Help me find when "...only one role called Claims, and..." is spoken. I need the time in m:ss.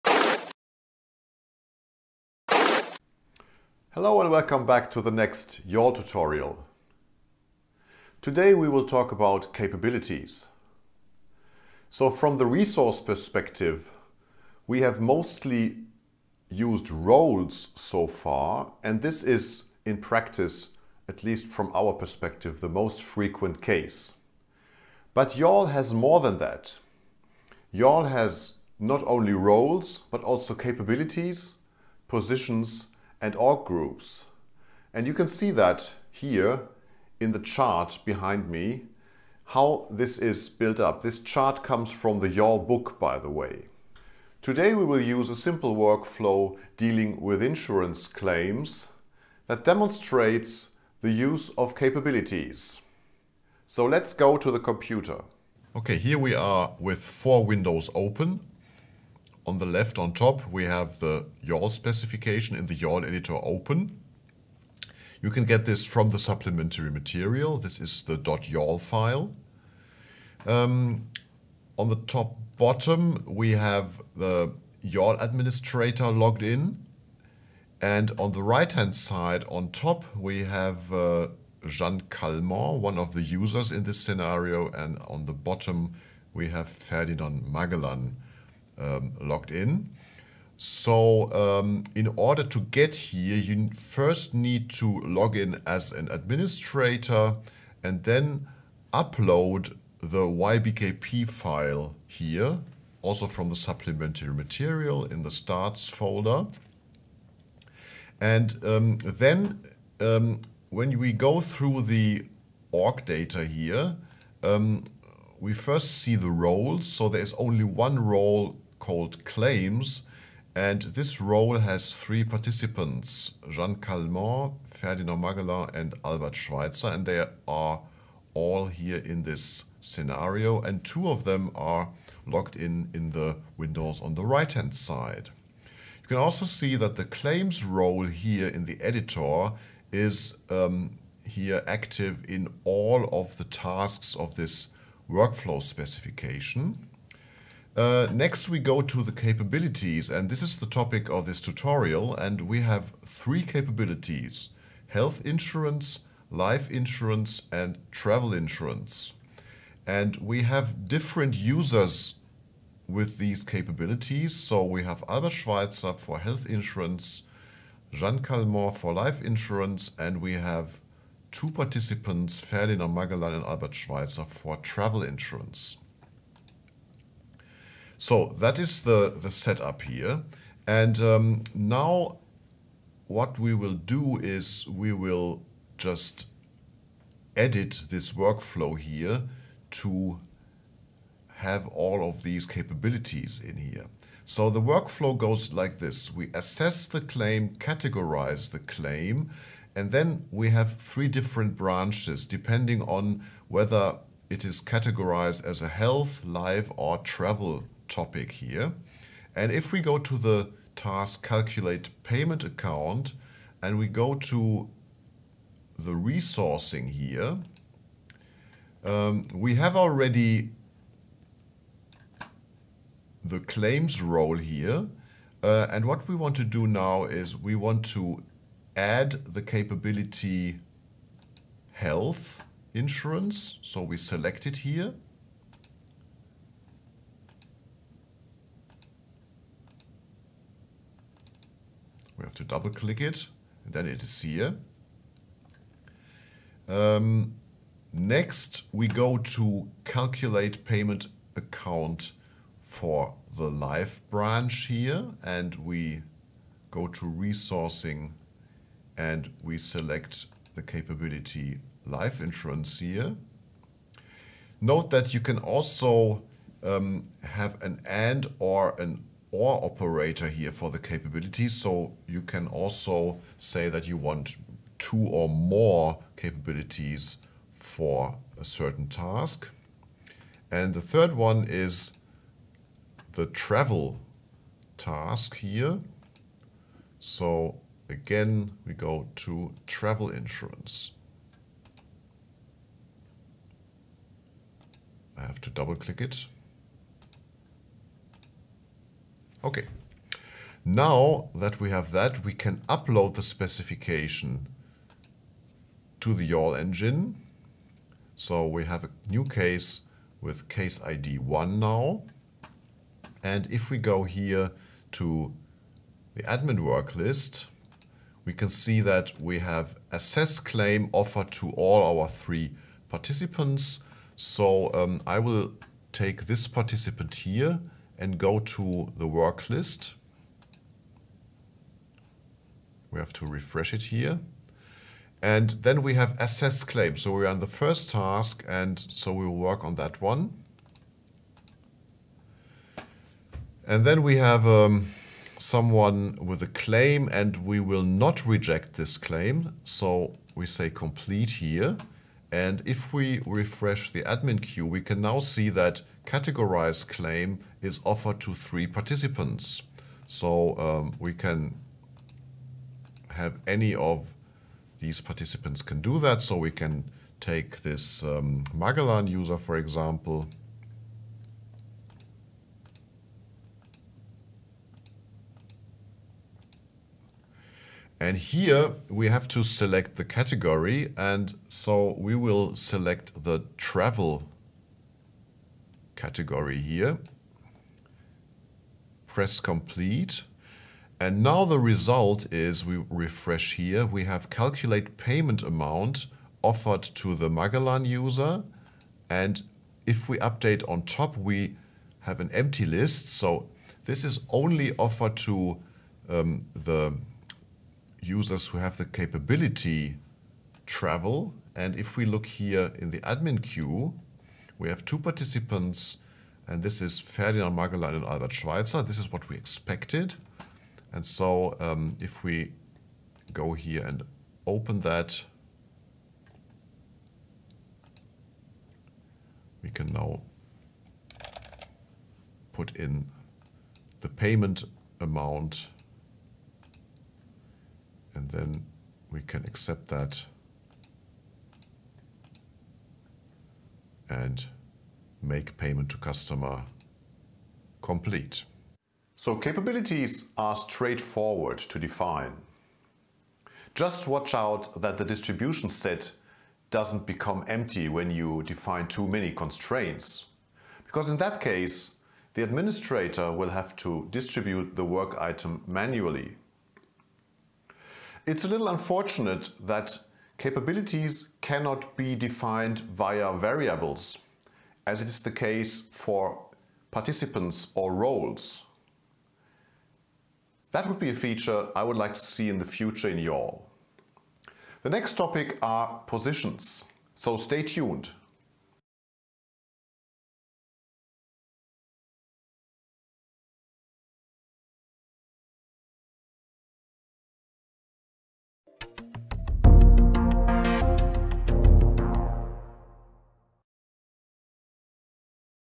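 1:57.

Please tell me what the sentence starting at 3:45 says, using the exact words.
Uh, and what we want to do now is we want to add the capability health insurance.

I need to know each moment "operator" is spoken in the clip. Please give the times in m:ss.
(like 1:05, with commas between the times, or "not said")
4:29.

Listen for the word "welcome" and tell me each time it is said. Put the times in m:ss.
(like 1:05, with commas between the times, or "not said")
0:04.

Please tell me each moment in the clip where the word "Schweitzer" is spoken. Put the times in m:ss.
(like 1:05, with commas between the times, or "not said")
2:06, 2:45, 2:53, 6:58.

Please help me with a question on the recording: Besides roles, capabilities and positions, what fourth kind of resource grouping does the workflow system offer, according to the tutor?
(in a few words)
org groups.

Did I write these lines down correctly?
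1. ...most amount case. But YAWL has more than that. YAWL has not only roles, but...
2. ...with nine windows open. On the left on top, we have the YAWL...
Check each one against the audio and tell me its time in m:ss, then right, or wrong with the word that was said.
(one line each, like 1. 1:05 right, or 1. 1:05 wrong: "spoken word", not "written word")
1. 0:22 wrong: "frequent", not "amount"
2. 0:56 wrong: "four", not "nine".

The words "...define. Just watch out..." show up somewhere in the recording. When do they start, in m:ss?
7:31.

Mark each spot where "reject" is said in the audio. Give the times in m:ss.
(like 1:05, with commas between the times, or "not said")
5:48.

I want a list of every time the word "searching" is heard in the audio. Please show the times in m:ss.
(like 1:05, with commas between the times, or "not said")
not said.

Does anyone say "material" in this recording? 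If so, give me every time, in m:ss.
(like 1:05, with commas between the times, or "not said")
1:06, 1:44.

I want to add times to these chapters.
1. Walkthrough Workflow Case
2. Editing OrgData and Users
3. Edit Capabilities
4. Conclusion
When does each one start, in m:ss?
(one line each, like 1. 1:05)
1. 4:59
2. 0:55
3. 3:13
4. 7:28.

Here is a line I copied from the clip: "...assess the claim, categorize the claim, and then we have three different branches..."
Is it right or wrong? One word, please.
right.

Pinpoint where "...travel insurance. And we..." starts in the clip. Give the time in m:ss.
2:37.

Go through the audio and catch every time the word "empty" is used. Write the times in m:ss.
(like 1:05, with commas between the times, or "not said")
6:42, 7:37.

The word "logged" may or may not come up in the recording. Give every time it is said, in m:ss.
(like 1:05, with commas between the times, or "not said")
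1:16, 1:29, 2:12.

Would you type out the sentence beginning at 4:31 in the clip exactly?
So you can also say that you want two or more capabilities for a certain task.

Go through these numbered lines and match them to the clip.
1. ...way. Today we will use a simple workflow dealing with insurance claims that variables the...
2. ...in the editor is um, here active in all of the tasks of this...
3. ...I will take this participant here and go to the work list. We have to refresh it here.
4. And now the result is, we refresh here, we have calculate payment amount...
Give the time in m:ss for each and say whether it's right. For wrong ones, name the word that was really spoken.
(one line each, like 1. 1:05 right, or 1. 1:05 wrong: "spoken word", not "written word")
1. 0:43 wrong: "demonstrates", not "variables"
2. 2:18 right
3. 5:25 right
4. 6:30 right.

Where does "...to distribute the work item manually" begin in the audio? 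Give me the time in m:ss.
7:43.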